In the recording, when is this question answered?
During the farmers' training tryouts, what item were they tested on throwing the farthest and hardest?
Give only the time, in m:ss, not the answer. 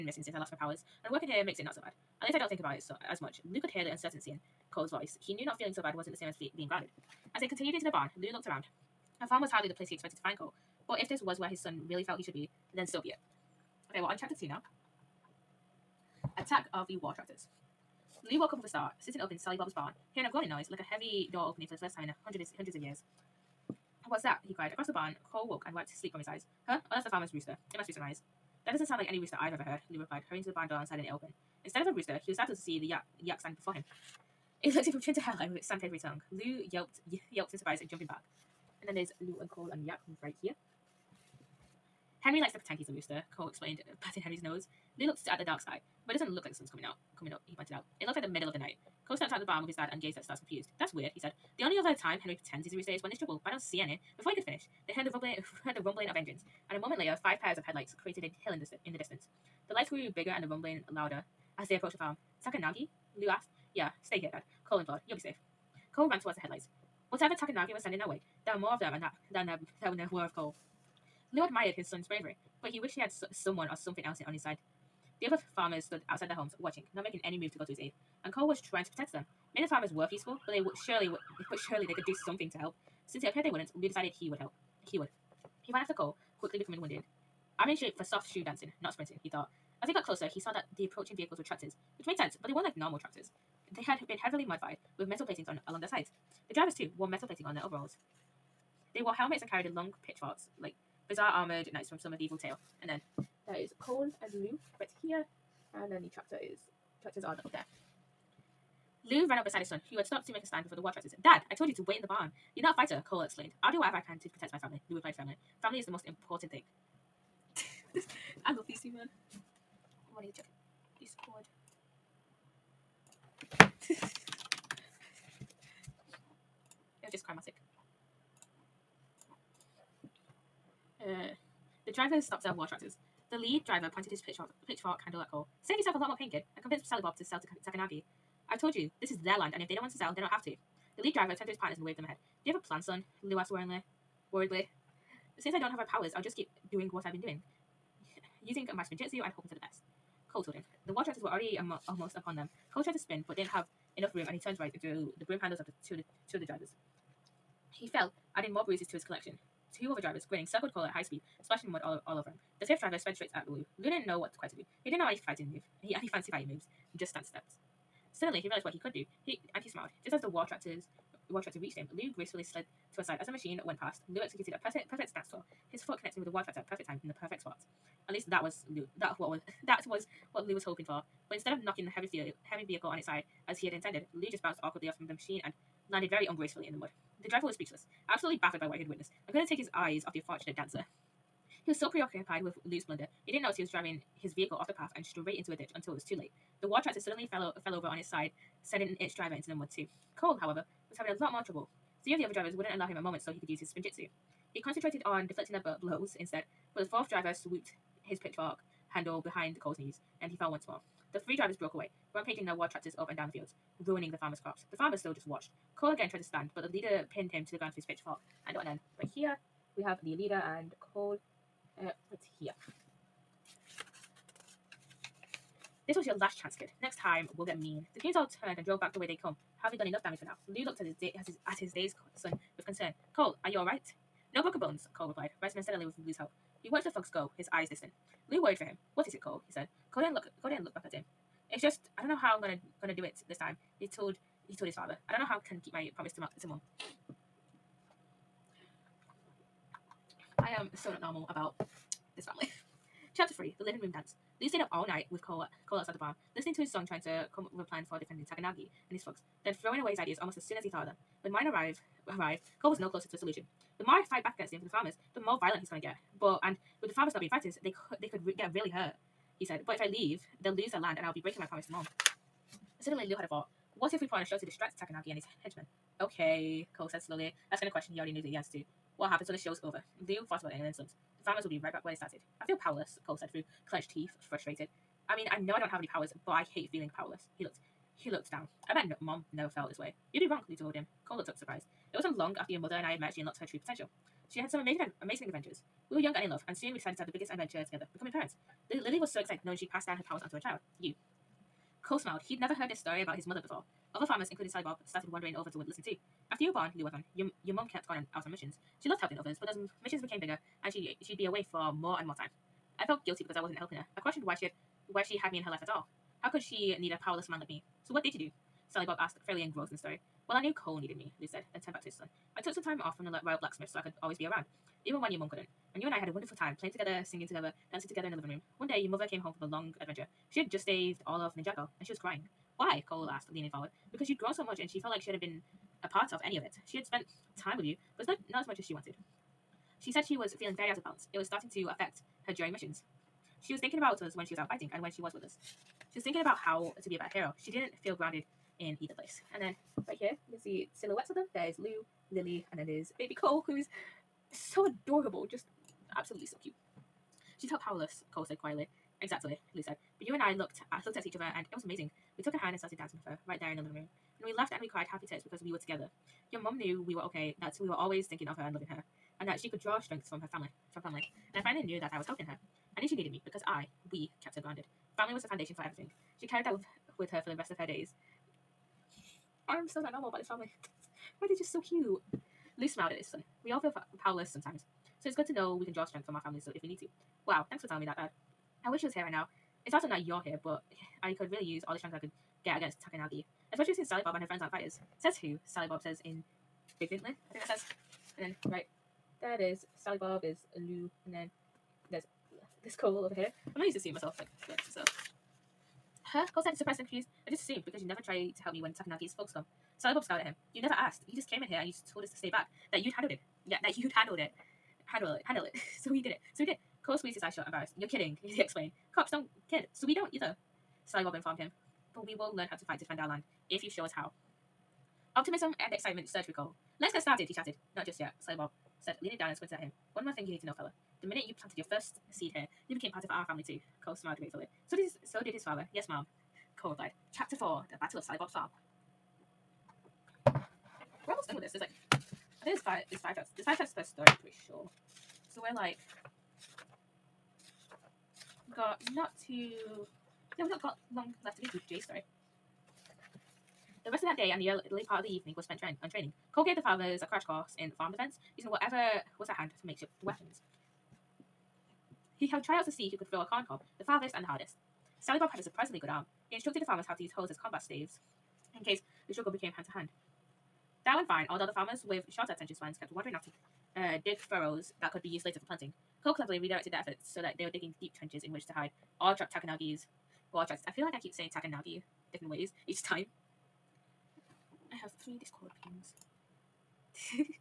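7:43.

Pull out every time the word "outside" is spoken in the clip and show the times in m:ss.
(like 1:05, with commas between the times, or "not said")
1:16, 4:15.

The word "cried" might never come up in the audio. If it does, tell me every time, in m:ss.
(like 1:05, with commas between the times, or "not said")
0:24, 6:04.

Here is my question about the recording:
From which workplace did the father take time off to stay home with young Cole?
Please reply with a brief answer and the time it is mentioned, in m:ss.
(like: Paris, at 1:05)
The Royal Blacksmith, at 5:23.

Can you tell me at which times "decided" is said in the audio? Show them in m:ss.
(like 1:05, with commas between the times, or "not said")
1:23, 4:56.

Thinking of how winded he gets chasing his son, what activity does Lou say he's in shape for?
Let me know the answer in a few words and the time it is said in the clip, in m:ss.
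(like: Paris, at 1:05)
Soft shoe dancing, at 1:28.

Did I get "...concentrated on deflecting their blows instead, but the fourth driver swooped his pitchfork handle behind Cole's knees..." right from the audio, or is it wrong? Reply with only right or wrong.
right.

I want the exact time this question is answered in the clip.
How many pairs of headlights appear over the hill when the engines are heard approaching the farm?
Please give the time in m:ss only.
0:57.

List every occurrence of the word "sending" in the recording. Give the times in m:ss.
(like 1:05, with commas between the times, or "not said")
1:07, 3:18.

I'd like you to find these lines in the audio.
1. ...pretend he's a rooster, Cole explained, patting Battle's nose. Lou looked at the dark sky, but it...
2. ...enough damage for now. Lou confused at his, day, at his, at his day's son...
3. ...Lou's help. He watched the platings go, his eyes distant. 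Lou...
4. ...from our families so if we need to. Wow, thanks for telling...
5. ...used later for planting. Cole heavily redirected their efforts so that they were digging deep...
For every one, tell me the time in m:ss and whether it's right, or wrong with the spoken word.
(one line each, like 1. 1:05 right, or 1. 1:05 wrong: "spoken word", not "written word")
1. 0:42 wrong: "Henry", not "Battle"
2. 3:49 wrong: "looked", not "confused"
3. 3:56 wrong: "thugs", not "platings"
4. 6:26 right
5. 7:55 wrong: "cleverly", not "heavily".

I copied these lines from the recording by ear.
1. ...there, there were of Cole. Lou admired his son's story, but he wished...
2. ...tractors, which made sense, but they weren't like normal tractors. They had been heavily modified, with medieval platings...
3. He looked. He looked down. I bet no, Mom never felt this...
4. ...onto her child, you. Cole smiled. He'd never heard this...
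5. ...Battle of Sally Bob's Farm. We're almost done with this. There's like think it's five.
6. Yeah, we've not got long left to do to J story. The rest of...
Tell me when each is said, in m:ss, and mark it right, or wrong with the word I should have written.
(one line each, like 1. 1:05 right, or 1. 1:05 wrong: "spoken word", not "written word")
1. 1:09 wrong: "bravery", not "story"
2. 1:31 wrong: "metal", not "medieval"
3. 4:47 right
4. 5:00 right
5. 7:17 right
6. 7:30 right.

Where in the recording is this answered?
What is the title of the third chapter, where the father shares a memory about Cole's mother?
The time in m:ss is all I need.
4:13.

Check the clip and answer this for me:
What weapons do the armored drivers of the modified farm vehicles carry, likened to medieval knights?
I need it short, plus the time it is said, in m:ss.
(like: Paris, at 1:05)
Pitchforks, at 1:39.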